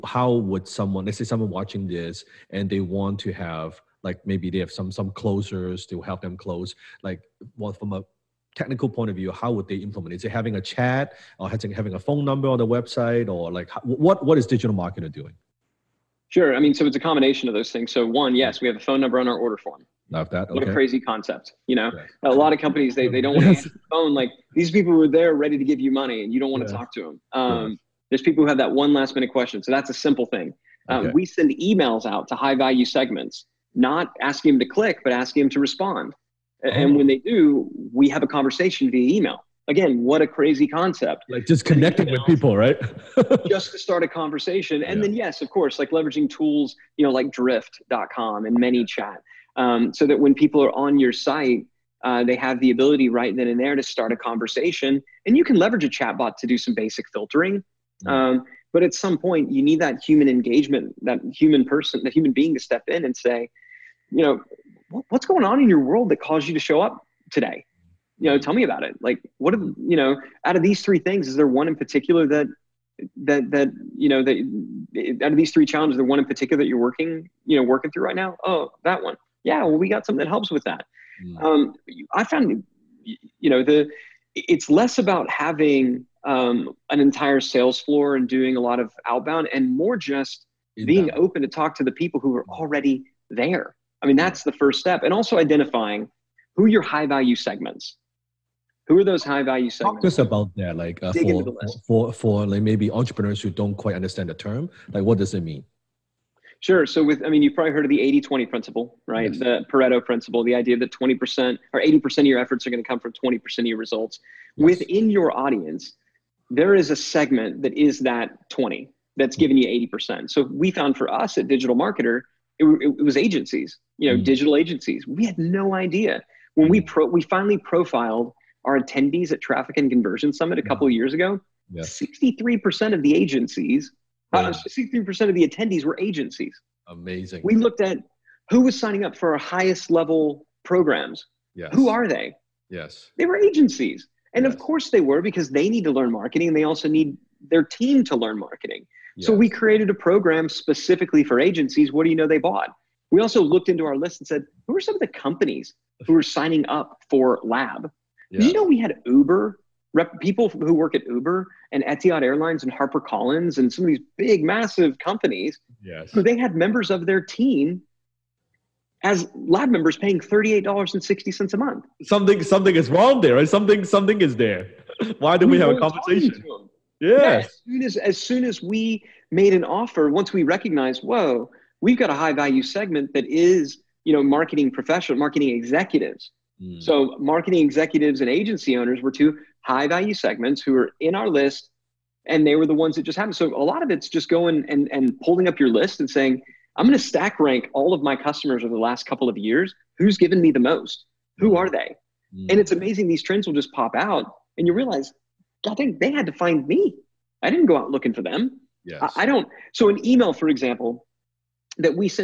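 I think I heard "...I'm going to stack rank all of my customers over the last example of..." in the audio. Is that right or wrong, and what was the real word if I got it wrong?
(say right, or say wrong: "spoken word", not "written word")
wrong: "couple", not "example".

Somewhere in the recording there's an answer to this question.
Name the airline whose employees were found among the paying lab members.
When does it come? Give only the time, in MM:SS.
02:41.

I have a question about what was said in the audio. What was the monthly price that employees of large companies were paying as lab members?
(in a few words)
$38.60.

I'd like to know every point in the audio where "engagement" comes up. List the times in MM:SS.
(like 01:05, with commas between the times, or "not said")
01:00.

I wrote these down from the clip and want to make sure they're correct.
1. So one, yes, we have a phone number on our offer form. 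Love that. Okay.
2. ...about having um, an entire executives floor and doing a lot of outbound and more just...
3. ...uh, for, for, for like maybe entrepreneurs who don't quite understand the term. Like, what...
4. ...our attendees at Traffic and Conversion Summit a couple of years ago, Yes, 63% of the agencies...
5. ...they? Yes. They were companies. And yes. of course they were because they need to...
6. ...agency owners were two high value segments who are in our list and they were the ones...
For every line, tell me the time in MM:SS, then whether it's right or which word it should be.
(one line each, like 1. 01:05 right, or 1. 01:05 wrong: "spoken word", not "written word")
1. 00:17 wrong: "order", not "offer"
2. 01:24 wrong: "sales", not "executives"
3. 01:41 right
4. 02:08 right
5. 02:22 wrong: "agencies", not "companies"
6. 03:08 right.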